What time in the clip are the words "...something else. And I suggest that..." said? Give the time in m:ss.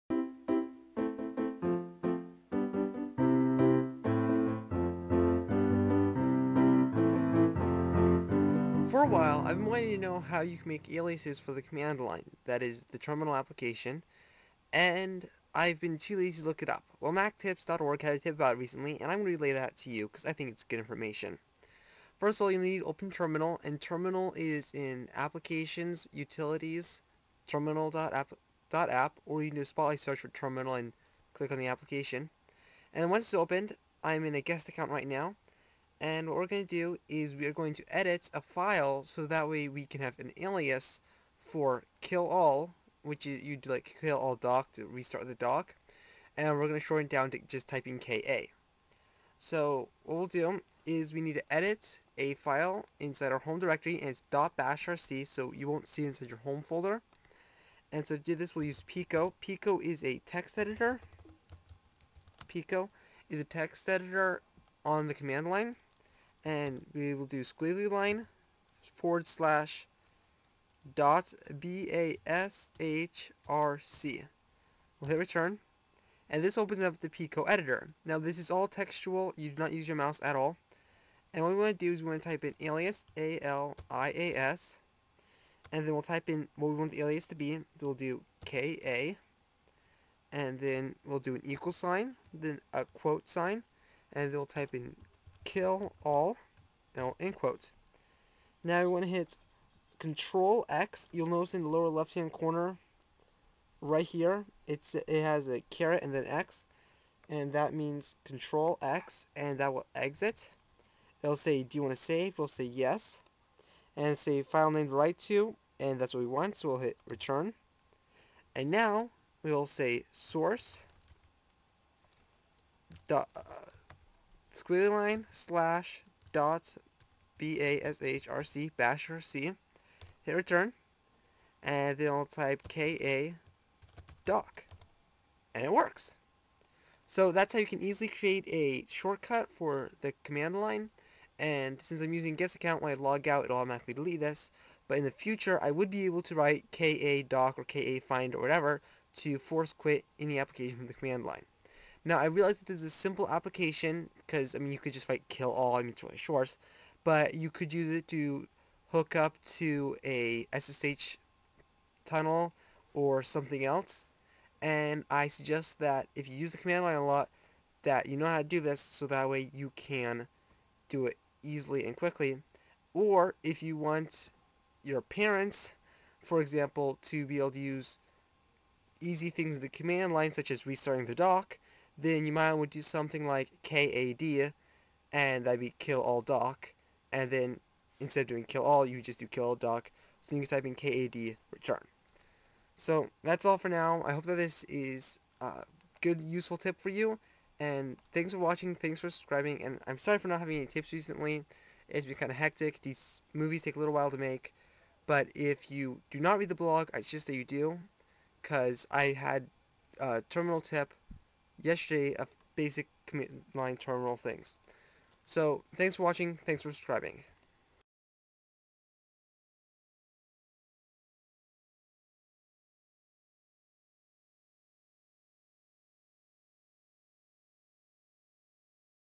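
2:43.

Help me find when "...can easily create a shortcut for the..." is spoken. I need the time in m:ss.
2:17.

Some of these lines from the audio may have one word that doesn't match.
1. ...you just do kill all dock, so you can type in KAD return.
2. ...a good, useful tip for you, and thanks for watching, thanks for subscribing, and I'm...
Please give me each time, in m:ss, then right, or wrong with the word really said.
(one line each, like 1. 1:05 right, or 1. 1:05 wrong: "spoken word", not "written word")
1. 3:08 right
2. 3:15 right.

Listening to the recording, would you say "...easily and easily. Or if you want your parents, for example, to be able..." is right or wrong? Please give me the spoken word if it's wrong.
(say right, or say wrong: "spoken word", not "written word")
wrong: "quickly", not "easily".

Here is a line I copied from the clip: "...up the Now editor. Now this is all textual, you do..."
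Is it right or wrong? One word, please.
wrong.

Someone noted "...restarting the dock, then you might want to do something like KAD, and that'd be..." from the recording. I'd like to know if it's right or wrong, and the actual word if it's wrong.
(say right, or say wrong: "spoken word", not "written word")
right.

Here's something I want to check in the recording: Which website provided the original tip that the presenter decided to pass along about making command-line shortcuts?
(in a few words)
MacTips.org.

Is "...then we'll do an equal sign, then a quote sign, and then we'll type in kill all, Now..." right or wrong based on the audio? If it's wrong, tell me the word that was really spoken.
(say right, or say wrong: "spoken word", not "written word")
right.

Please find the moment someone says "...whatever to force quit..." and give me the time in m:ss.
2:28.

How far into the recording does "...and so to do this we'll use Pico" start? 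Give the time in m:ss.
0:57.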